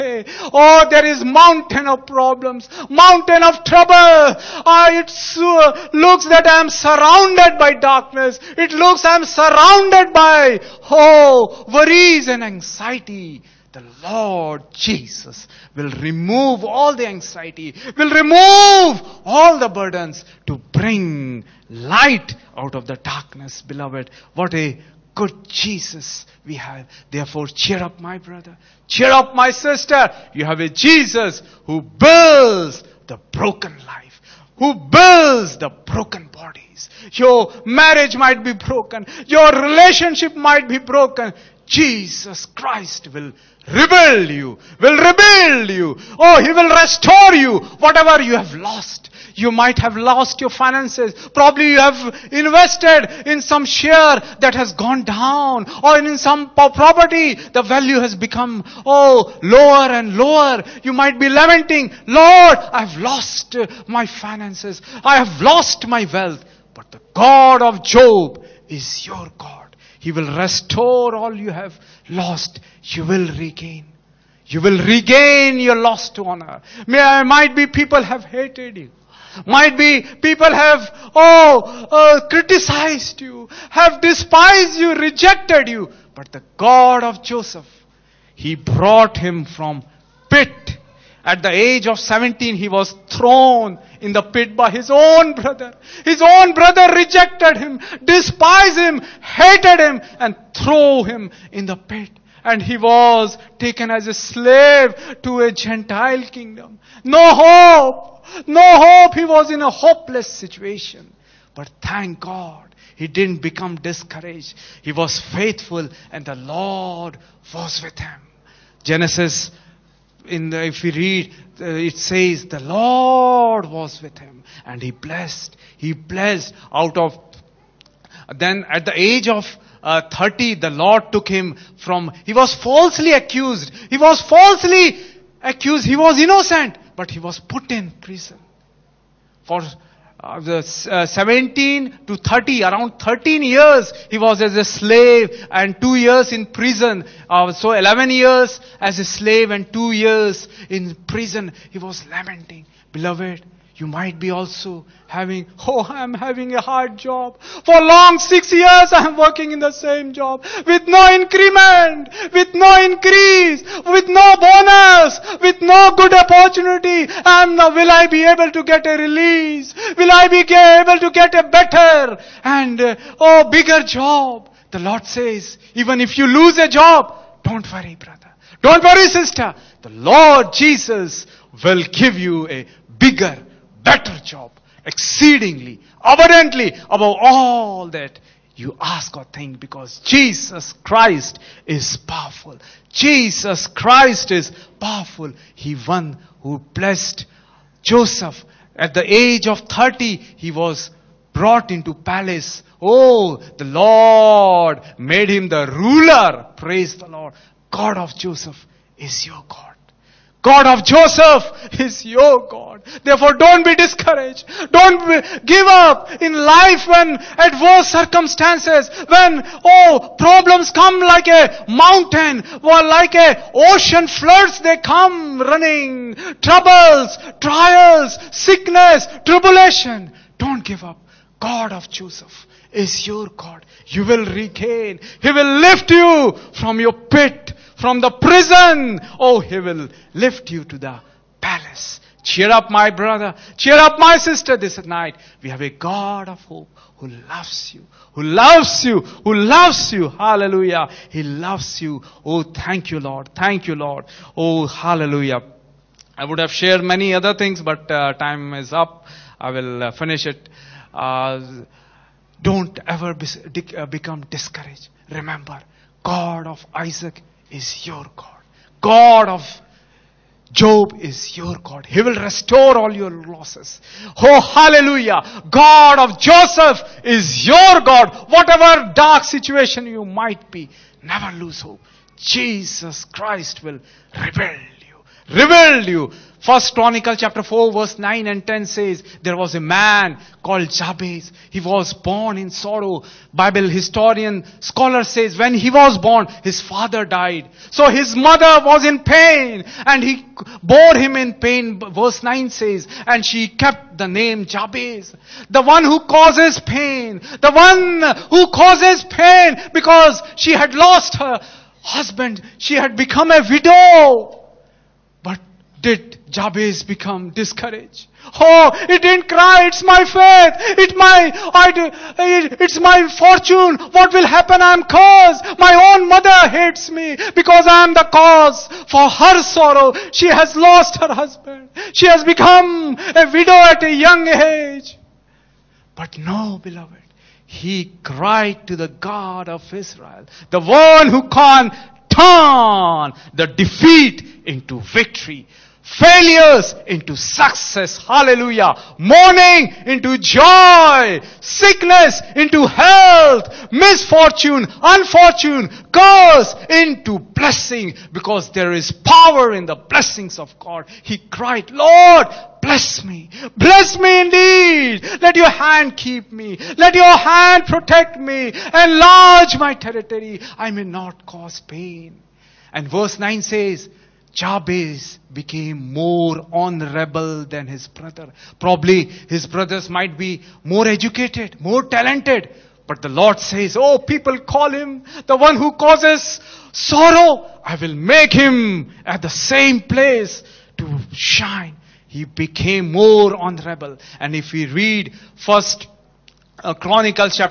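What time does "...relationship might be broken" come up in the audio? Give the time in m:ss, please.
0:39.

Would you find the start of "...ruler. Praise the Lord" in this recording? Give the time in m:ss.
3:25.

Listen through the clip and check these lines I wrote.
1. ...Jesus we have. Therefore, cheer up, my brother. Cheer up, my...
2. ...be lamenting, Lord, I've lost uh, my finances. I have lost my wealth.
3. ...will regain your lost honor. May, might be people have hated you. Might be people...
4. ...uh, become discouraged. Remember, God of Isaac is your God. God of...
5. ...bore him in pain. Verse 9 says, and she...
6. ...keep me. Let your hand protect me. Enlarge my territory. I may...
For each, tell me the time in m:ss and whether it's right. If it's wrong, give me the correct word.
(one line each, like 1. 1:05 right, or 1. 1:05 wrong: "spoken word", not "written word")
1. 0:25 right
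2. 1:01 right
3. 1:14 right
4. 4:23 right
5. 5:00 right
6. 6:05 right.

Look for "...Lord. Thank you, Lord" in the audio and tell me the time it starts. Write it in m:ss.
4:12.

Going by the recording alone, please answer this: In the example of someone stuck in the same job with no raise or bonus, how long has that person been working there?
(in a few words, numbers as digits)
6 years.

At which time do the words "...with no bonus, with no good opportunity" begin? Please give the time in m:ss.
2:43.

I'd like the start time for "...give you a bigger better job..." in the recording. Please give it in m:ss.
3:01.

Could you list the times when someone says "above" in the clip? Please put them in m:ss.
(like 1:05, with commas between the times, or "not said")
3:06.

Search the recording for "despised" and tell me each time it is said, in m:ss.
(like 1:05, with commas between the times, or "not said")
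1:24, 1:38.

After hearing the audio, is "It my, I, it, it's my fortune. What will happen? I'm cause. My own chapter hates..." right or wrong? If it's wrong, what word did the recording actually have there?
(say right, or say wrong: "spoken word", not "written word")
wrong: "mother", not "chapter".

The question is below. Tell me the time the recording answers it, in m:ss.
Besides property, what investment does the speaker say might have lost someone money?
0:53.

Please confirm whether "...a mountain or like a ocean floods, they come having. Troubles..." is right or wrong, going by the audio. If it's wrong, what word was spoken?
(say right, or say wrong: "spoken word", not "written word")
wrong: "running", not "having".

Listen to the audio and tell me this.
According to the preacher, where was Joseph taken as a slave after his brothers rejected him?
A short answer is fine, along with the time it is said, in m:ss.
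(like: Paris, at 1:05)
A Gentile kingdom, at 1:45.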